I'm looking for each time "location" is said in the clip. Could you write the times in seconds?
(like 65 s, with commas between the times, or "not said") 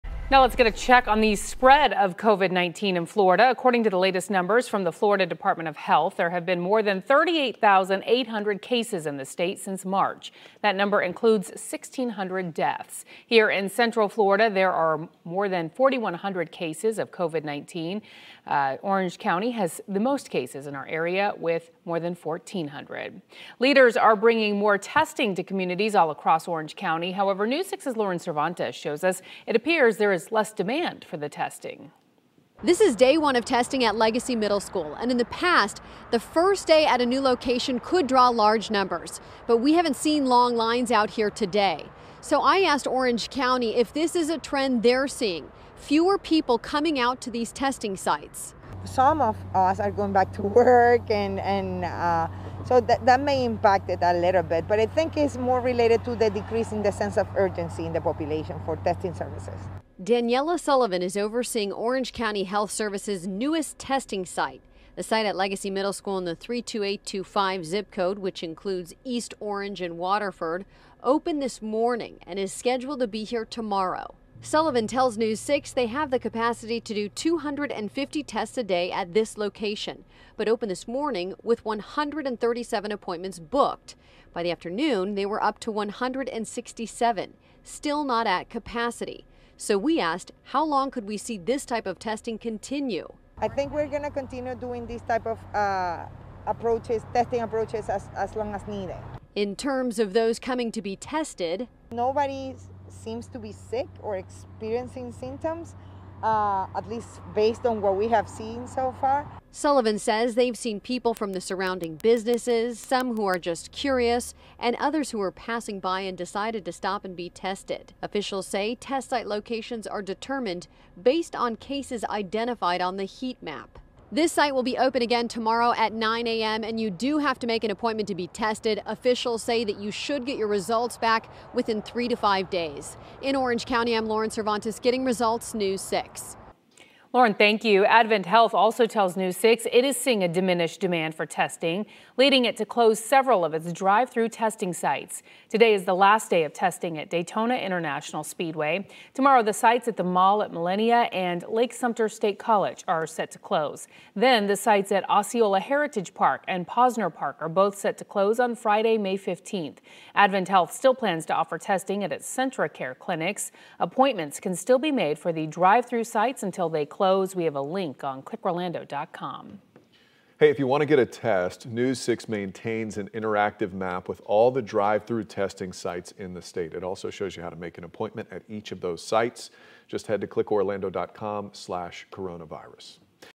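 37 s, 79 s, 119 s.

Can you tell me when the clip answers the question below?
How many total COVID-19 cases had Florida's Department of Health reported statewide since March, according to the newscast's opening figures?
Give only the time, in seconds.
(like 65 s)
7 s.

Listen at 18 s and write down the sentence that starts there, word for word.
Uh, Orange County has the most cases in our area with more than 1,400.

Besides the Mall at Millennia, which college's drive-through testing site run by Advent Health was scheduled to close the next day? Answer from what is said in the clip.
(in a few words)
Lake Sumter State College.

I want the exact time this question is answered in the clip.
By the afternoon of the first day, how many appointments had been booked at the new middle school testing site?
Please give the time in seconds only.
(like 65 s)
85 s.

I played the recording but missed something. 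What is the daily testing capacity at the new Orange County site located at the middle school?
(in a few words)
250.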